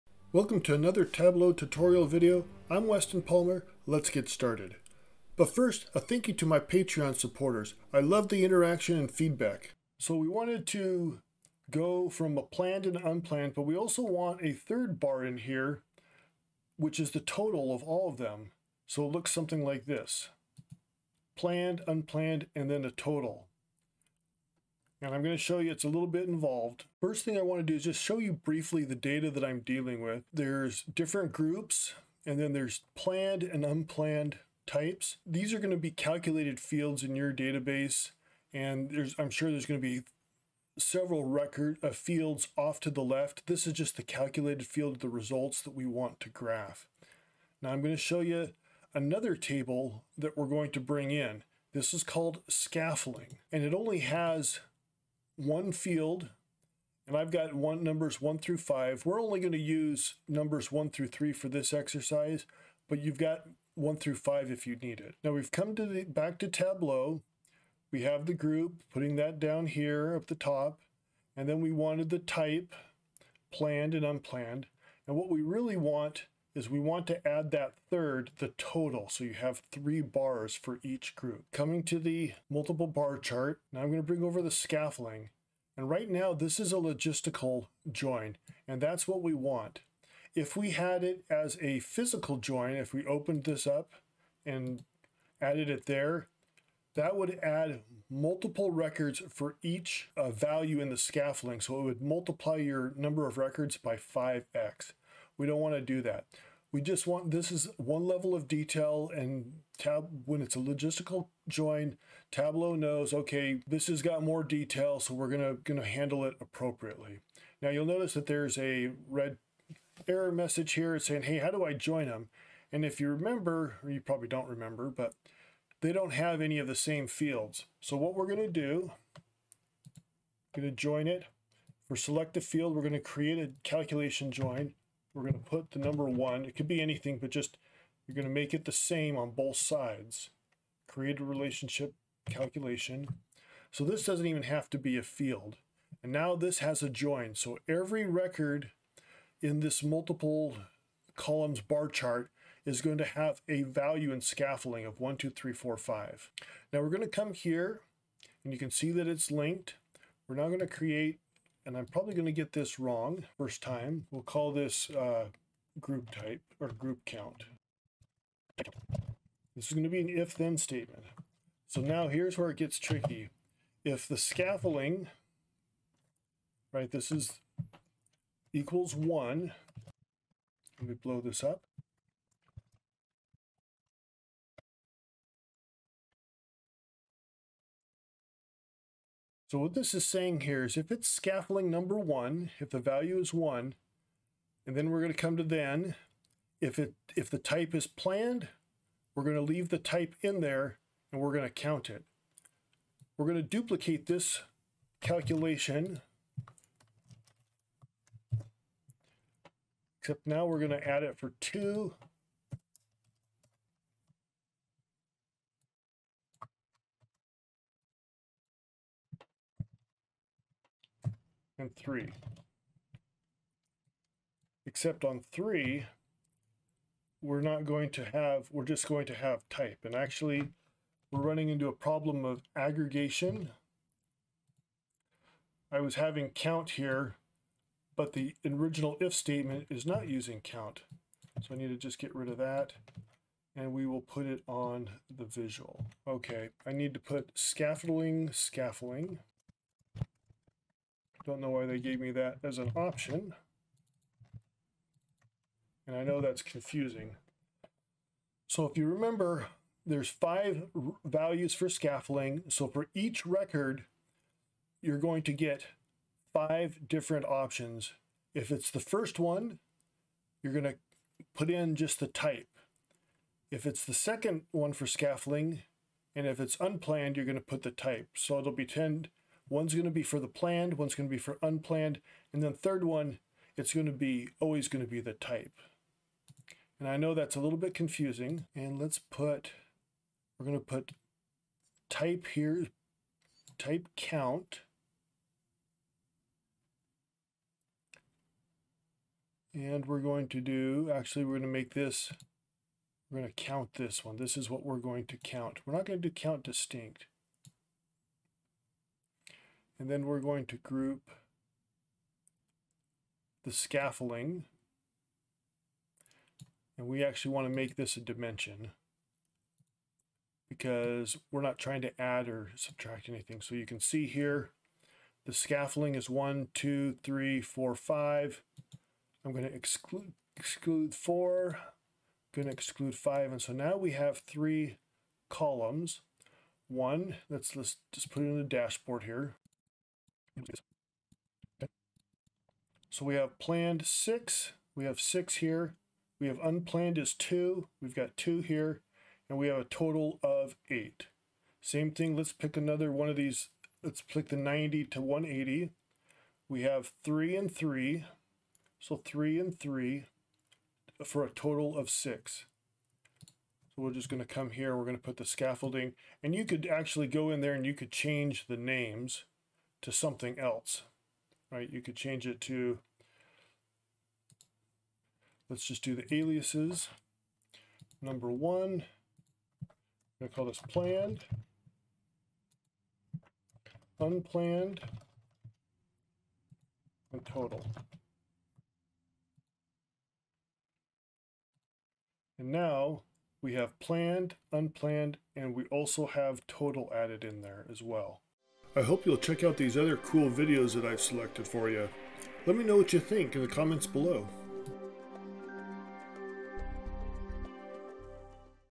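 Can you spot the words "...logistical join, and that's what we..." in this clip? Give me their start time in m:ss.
1:26.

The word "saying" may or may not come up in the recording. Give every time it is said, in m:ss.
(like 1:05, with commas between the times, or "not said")
2:00, 3:10.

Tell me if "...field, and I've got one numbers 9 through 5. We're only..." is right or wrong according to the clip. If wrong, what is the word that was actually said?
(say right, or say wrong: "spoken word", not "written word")
wrong: "1", not "9".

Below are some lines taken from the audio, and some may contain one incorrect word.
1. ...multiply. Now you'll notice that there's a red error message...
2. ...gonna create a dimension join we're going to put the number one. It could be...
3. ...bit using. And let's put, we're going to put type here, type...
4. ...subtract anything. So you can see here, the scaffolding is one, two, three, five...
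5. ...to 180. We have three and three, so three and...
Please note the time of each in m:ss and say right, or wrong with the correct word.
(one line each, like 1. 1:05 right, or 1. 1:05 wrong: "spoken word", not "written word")
1. 1:56 wrong: "appropriately", not "multiply"
2. 2:12 wrong: "calculation", not "dimension"
3. 4:47 wrong: "confusing", not "using"
4. 5:22 wrong: "four", not "five"
5. 5:54 right.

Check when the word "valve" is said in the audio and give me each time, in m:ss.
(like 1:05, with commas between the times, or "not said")
not said.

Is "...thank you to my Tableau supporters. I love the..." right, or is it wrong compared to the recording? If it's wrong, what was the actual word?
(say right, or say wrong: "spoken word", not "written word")
wrong: "Patreon", not "Tableau".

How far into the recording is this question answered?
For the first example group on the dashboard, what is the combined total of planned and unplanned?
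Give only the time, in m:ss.
5:49.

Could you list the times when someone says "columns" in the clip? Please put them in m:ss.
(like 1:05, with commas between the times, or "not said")
2:31, 5:35.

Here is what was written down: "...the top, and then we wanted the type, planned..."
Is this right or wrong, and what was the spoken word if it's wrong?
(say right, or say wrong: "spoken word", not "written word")
right.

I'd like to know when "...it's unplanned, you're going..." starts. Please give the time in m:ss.
4:36.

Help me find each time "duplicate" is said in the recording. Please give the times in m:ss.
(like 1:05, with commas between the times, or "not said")
3:23.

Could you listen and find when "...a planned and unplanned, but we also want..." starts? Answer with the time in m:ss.
0:12.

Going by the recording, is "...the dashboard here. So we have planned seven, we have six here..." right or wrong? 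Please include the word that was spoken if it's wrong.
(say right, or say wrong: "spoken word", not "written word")
wrong: "six", not "seven".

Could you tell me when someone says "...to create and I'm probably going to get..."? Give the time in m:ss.
2:40.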